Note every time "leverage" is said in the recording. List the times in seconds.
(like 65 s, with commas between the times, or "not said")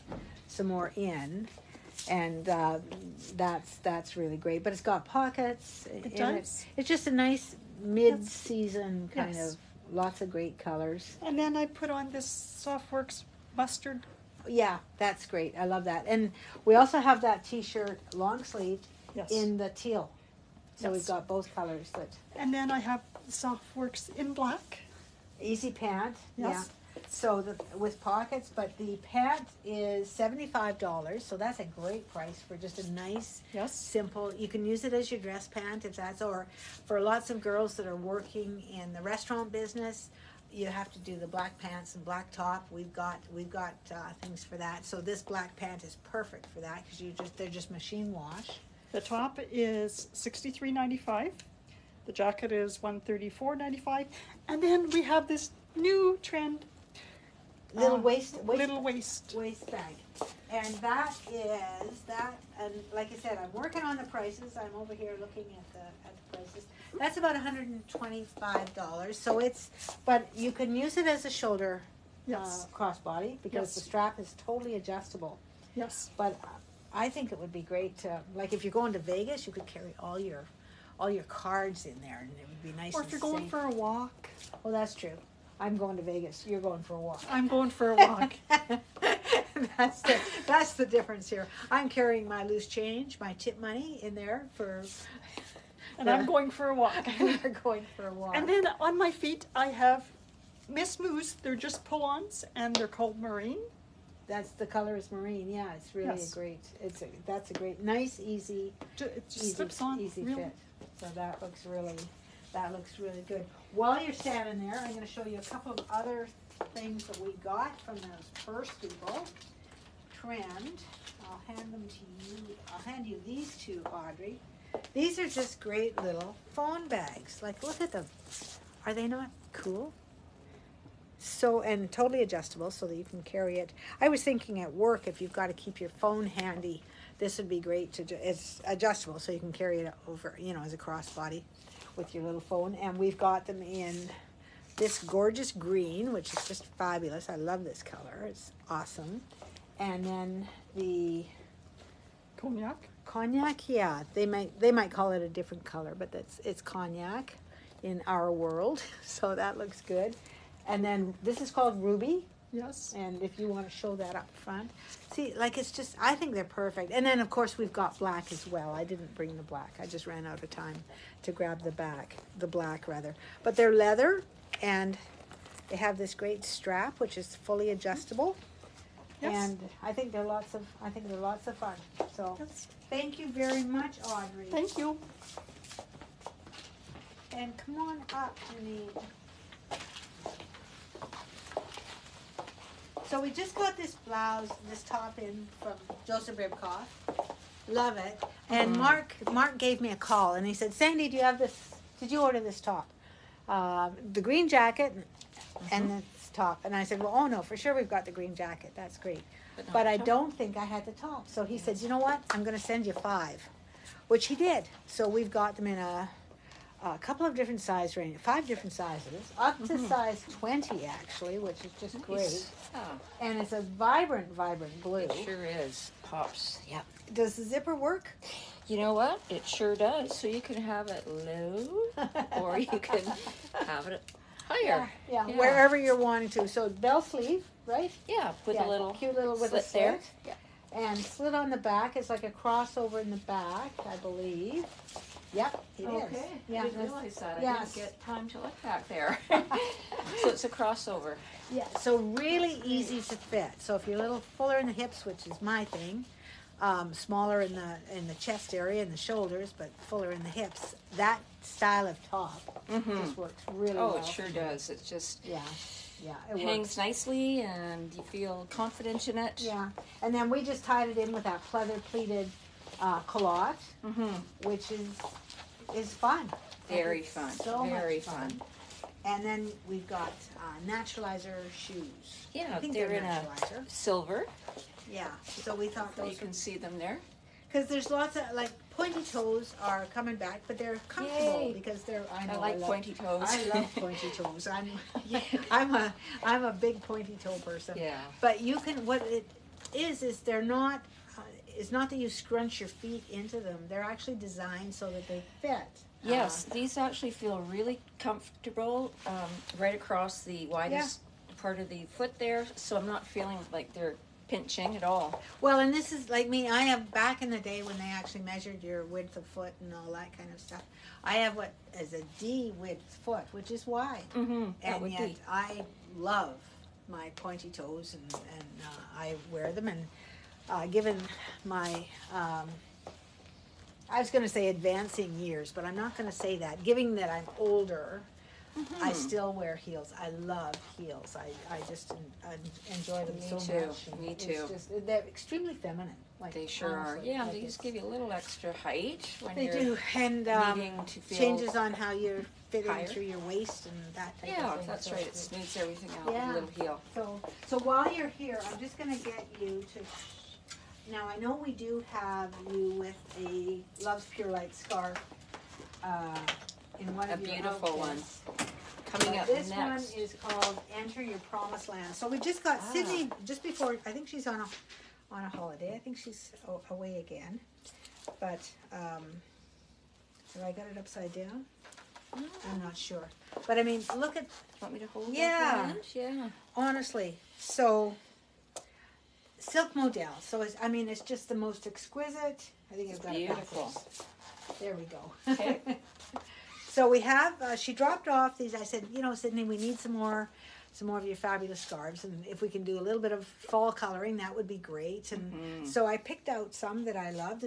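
not said.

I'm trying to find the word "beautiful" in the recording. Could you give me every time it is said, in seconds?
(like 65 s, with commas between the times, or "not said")
367 s, 393 s.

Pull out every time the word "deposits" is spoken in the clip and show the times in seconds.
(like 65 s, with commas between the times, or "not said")
not said.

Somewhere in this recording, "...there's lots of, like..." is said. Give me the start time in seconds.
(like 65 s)
287 s.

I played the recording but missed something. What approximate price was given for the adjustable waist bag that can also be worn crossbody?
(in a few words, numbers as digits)
$125.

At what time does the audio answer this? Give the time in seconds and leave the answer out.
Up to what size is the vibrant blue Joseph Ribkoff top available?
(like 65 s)
219 s.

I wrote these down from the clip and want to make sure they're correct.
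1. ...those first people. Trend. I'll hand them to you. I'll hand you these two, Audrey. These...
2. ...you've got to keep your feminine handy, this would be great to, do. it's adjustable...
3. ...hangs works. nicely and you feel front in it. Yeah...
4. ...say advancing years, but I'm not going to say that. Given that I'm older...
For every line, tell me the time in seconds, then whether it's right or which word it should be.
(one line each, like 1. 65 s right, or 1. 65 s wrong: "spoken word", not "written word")
1. 117 s right
2. 135 s wrong: "phone", not "feminine"
3. 266 s wrong: "confident", not "front"
4. 334 s right.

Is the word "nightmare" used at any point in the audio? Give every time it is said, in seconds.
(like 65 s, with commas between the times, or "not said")
not said.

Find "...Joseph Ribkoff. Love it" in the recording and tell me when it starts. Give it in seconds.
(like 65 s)
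196 s.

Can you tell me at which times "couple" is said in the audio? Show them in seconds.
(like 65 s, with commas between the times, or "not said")
115 s, 216 s.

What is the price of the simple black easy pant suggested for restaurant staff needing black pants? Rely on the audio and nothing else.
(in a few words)
$75.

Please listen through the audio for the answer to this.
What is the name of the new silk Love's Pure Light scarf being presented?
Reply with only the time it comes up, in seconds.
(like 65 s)
370 s.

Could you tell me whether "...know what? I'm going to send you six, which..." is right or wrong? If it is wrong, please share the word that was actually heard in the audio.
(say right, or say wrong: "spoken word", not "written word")
wrong: "five", not "six".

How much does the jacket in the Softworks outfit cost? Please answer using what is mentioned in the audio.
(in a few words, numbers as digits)
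$134.95.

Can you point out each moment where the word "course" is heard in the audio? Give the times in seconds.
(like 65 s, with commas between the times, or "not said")
167 s.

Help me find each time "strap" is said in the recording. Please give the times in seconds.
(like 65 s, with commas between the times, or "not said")
73 s, 176 s.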